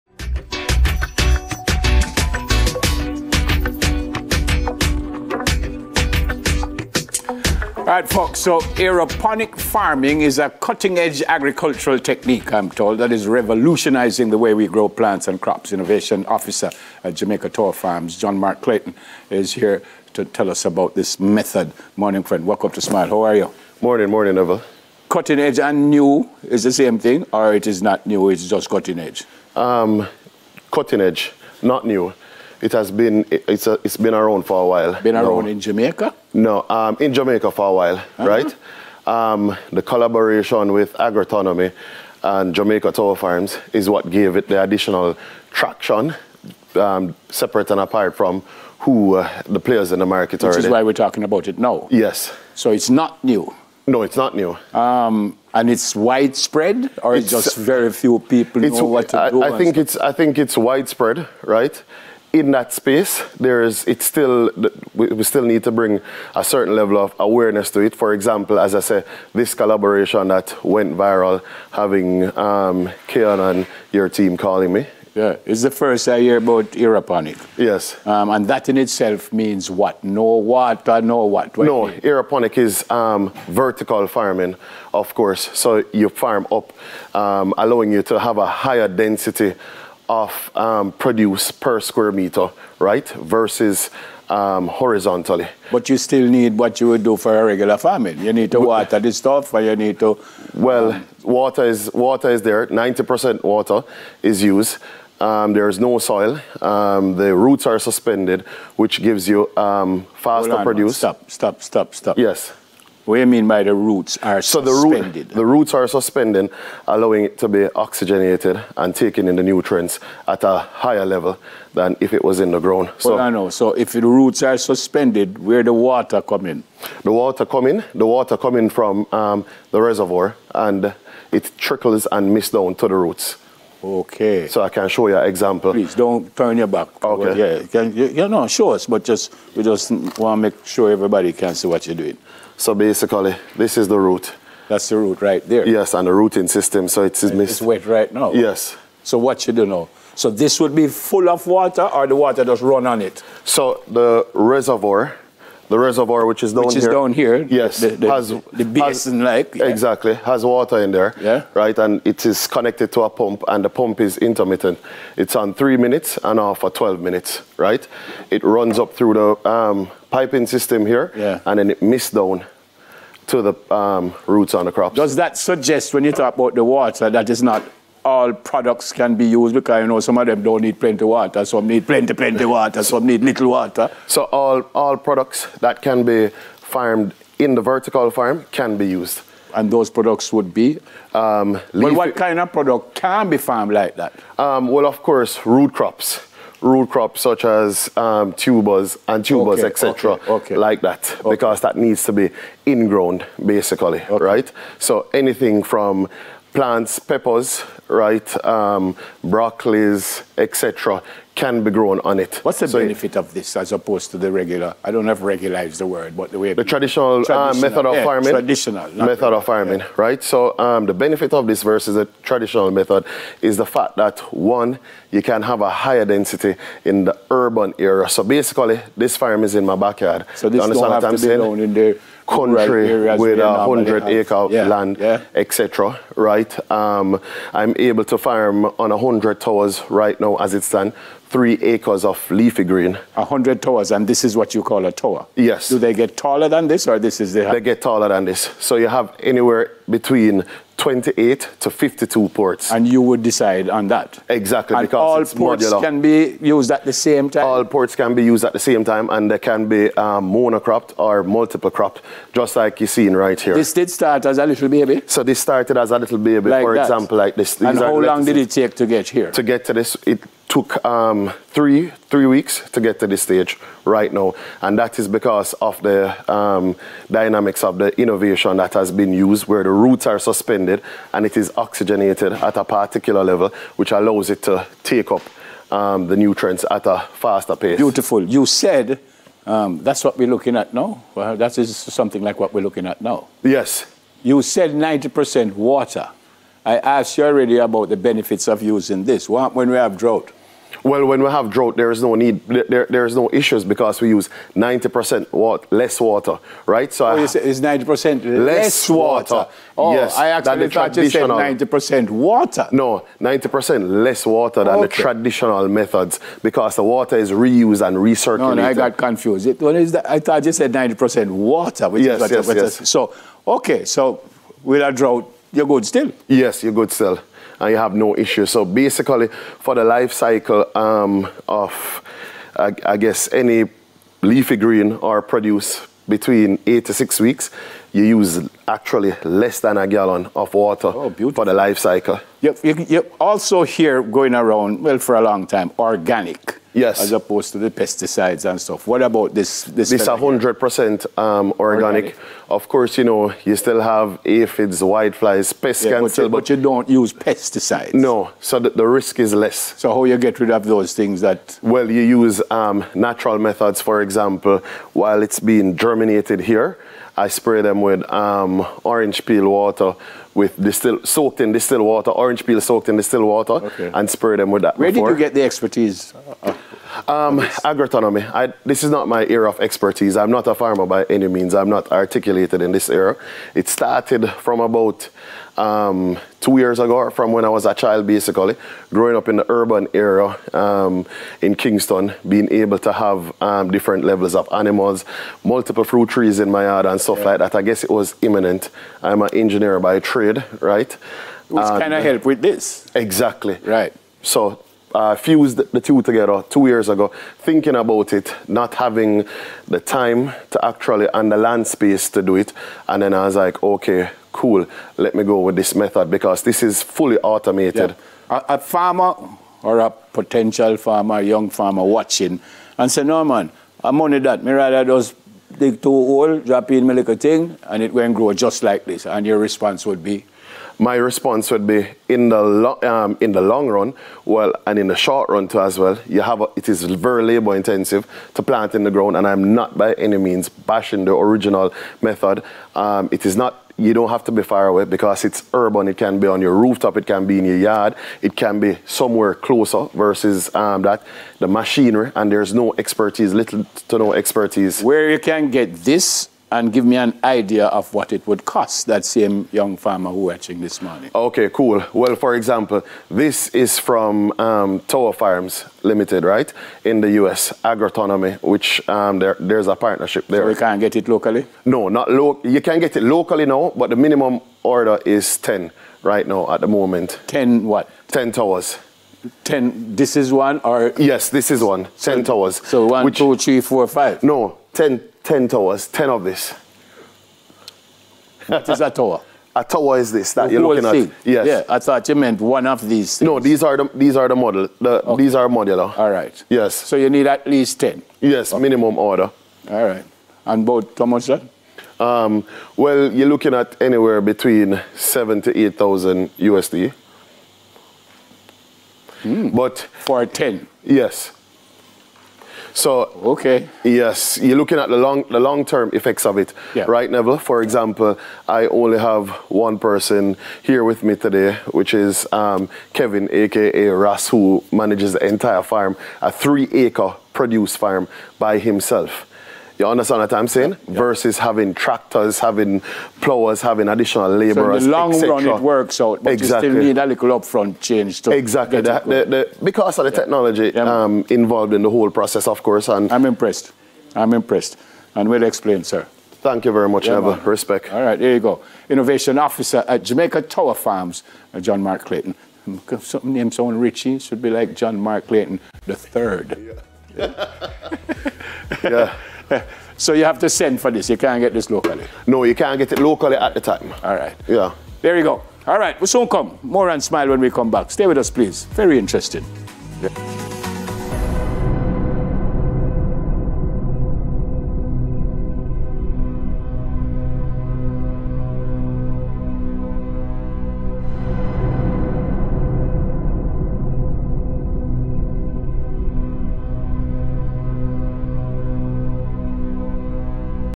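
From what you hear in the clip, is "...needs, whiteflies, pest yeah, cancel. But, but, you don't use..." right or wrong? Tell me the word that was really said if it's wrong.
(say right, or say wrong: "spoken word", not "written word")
wrong: "aphids", not "needs".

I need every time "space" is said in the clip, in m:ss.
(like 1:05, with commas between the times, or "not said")
1:02, 6:51.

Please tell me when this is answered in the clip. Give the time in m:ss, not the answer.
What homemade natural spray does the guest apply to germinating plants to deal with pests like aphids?
6:08.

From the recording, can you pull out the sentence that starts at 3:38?
Traditional method regular, of farming, yeah.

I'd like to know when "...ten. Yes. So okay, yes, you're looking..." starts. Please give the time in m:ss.
8:30.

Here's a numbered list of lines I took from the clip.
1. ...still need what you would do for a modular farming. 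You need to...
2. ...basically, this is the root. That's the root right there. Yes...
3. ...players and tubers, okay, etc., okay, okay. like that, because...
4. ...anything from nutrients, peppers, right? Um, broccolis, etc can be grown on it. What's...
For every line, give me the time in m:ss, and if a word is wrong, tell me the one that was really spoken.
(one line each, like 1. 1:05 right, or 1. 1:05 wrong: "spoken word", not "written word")
1. 1:35 wrong: "regular", not "modular"
2. 2:22 right
3. 3:18 wrong: "tubers", not "players"
4. 3:25 wrong: "plants", not "nutrients".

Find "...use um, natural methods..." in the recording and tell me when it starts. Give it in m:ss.
6:02.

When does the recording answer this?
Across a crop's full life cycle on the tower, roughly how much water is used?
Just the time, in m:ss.
5:39.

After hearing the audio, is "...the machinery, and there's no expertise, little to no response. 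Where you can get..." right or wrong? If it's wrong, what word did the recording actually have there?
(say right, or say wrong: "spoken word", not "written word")
wrong: "expertise", not "response".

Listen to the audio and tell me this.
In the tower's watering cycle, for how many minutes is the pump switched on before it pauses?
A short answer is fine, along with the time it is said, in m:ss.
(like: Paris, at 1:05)
3 minutes, at 2:45.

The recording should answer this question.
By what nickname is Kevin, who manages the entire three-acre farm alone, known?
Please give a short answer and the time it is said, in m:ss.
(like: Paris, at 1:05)
Ras, at 8:43.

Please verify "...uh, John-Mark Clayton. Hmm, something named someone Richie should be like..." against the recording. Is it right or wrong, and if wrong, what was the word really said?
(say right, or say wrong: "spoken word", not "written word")
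right.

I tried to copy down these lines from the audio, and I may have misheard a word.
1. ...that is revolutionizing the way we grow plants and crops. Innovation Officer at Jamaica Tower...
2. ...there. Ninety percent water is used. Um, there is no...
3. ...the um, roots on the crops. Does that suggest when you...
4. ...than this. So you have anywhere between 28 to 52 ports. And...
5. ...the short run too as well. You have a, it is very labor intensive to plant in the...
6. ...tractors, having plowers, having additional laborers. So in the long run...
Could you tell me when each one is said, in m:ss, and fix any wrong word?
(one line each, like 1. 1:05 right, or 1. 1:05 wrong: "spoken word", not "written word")
1. 0:12 right
2. 1:42 right
3. 2:53 right
4. 4:08 right
5. 7:14 right
6. 8:51 right.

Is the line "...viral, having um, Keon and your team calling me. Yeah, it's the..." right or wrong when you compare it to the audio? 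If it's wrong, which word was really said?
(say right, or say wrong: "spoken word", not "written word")
right.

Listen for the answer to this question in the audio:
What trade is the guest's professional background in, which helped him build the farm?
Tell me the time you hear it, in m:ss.
6:39.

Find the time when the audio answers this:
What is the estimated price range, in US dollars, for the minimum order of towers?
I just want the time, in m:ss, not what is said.
8:24.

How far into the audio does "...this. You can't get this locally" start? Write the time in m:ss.
9:20.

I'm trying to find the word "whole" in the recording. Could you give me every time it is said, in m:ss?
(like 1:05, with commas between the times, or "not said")
9:01.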